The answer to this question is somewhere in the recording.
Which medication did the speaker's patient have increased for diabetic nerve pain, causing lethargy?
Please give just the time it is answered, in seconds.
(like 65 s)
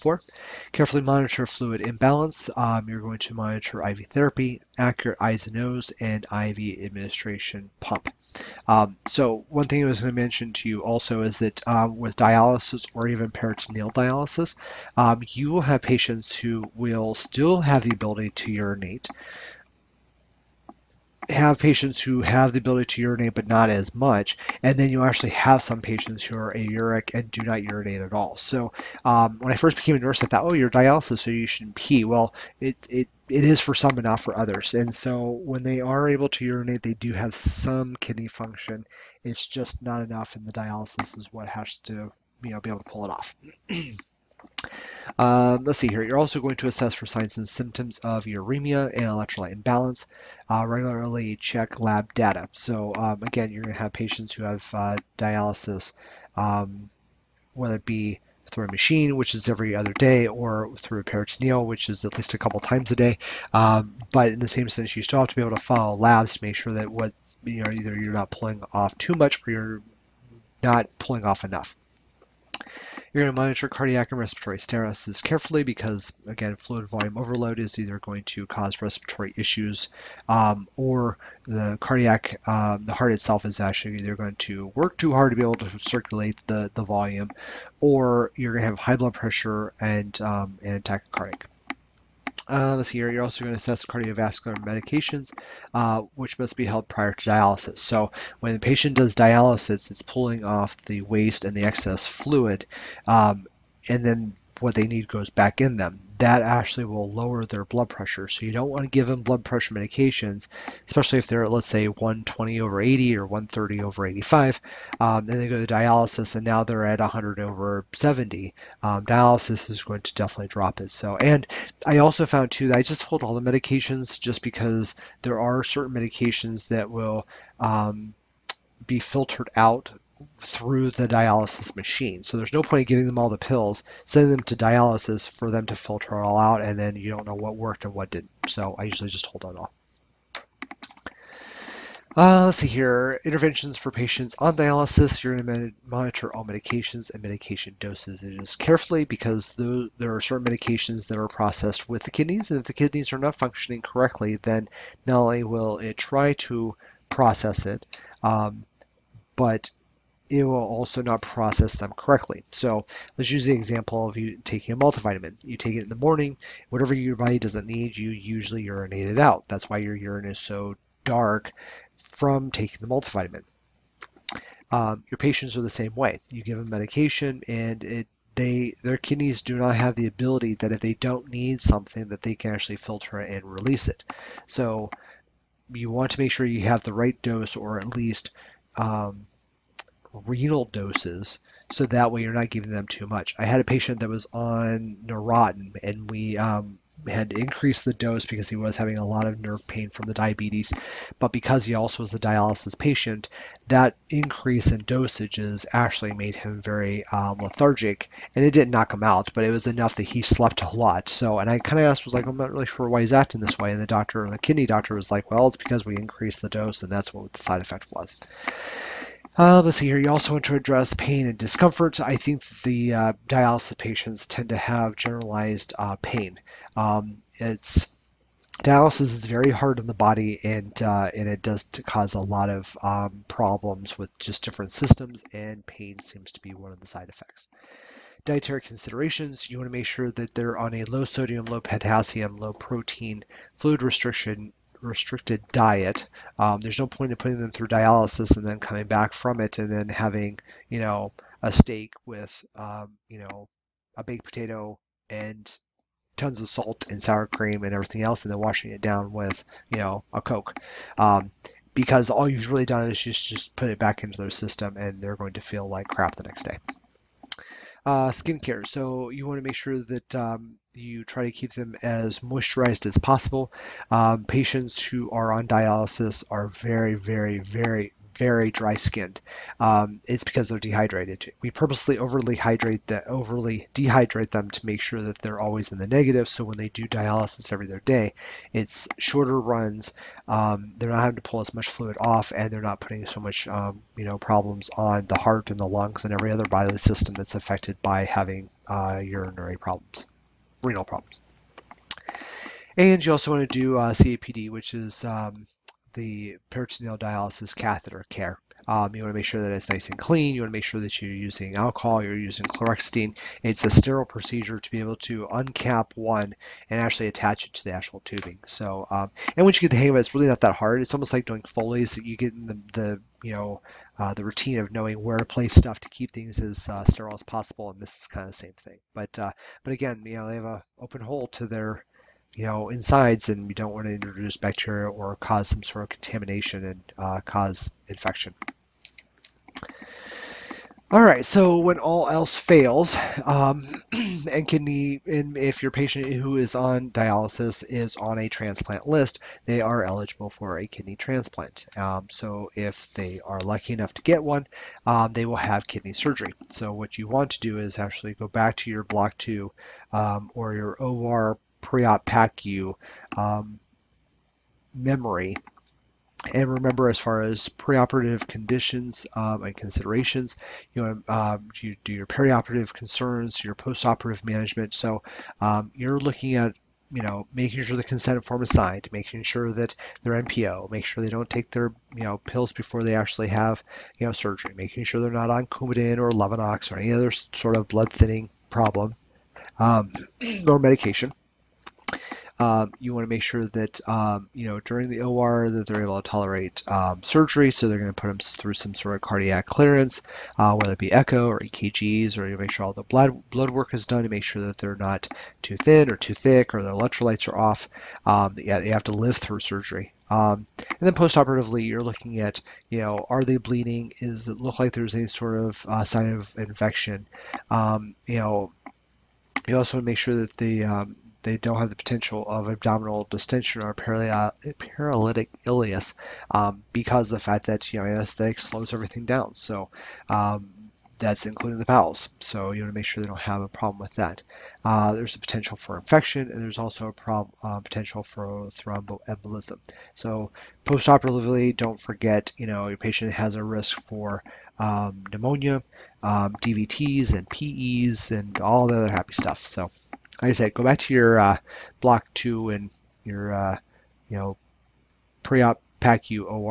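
195 s.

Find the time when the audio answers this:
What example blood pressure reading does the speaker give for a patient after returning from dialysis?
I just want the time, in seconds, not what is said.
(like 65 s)
116 s.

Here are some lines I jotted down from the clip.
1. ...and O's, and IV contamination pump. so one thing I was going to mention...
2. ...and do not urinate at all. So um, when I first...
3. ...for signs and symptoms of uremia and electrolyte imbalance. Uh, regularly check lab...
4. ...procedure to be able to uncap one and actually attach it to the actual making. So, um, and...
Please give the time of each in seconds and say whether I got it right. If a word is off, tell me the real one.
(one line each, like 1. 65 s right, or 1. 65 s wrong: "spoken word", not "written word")
1. 5 s wrong: "administration", not "contamination"
2. 27 s right
3. 46 s right
4. 314 s wrong: "tubing", not "making".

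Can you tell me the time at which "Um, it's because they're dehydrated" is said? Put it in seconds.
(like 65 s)
279 s.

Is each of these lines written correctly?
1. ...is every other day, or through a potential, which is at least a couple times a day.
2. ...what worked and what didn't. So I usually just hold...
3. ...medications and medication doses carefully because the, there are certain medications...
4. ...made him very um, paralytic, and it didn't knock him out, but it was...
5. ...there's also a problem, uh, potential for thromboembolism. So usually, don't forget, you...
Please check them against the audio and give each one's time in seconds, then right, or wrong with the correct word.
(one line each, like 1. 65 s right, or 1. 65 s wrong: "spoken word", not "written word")
1. 59 s wrong: "peritoneal", not "potential"
2. 137 s right
3. 146 s right
4. 206 s wrong: "lethargic", not "paralytic"
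5. 436 s wrong: "postoperatively", not "usually".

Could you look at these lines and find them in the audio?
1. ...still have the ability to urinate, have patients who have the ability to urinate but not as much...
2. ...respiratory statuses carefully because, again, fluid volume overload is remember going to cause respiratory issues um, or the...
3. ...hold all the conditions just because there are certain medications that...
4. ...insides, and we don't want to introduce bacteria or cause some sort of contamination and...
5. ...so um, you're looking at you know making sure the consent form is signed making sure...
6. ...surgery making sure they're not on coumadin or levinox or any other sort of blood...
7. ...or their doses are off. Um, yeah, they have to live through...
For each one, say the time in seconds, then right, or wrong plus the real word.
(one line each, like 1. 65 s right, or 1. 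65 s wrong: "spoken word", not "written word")
1. 17 s right
2. 74 s wrong: "either", not "remember"
3. 123 s wrong: "medications", not "conditions"
4. 332 s right
5. 374 s right
6. 384 s right
7. 406 s wrong: "electrolytes", not "doses".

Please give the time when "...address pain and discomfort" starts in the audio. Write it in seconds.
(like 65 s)
220 s.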